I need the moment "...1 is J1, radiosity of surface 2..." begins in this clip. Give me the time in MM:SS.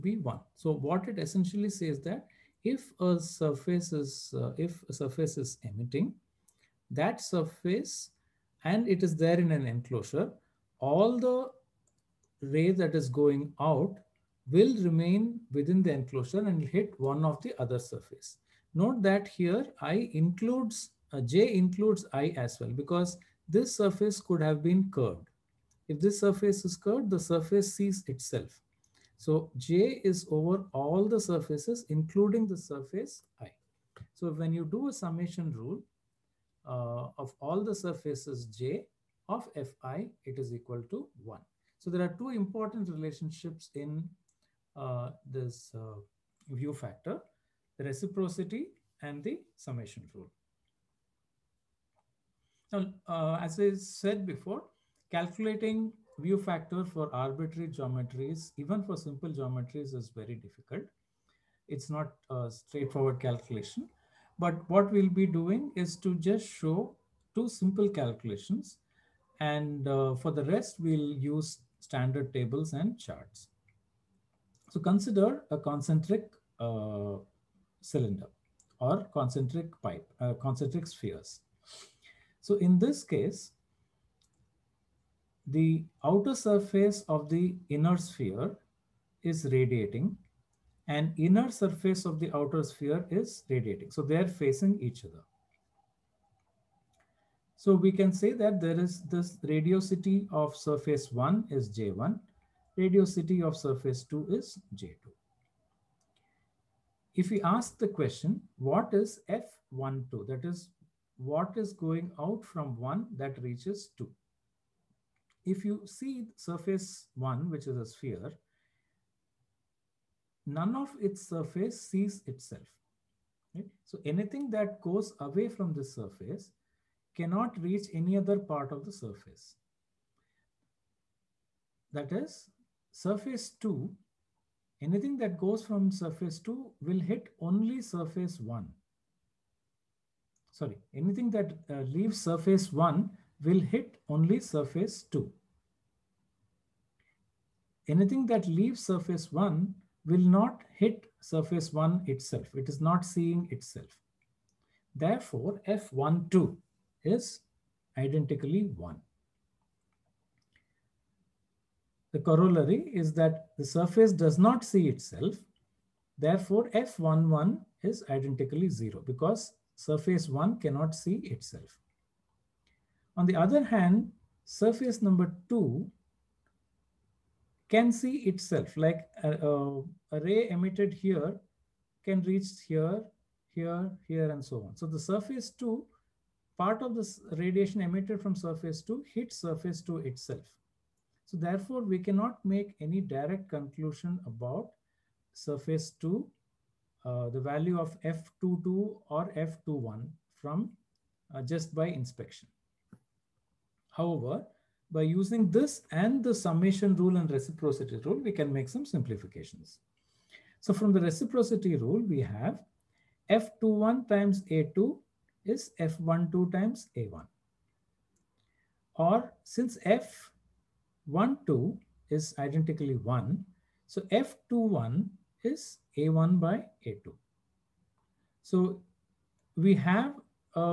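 01:41.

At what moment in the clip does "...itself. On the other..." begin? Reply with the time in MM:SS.
02:51.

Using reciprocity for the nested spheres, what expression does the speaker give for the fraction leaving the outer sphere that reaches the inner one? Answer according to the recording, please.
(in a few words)
A1 by A2.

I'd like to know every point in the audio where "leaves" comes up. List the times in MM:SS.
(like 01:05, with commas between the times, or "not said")
02:21, 02:28.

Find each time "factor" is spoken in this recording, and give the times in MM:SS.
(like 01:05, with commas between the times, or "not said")
00:46, 00:56.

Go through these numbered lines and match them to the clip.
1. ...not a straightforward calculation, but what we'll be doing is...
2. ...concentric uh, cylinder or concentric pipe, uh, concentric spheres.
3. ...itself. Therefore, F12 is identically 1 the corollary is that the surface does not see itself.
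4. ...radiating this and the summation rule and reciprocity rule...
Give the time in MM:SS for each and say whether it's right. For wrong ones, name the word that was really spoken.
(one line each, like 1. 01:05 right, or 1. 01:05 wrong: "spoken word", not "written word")
1. 01:01 right
2. 01:15 right
3. 02:33 right
4. 03:25 wrong: "using", not "radiating".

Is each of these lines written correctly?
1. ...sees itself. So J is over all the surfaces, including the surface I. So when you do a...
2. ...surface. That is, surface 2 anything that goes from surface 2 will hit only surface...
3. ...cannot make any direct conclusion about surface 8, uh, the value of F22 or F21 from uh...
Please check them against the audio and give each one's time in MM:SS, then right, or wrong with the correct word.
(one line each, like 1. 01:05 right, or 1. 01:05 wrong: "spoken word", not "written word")
1. 00:27 right
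2. 02:08 right
3. 03:11 wrong: "2", not "8".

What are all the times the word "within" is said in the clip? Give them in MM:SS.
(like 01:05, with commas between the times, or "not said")
00:15.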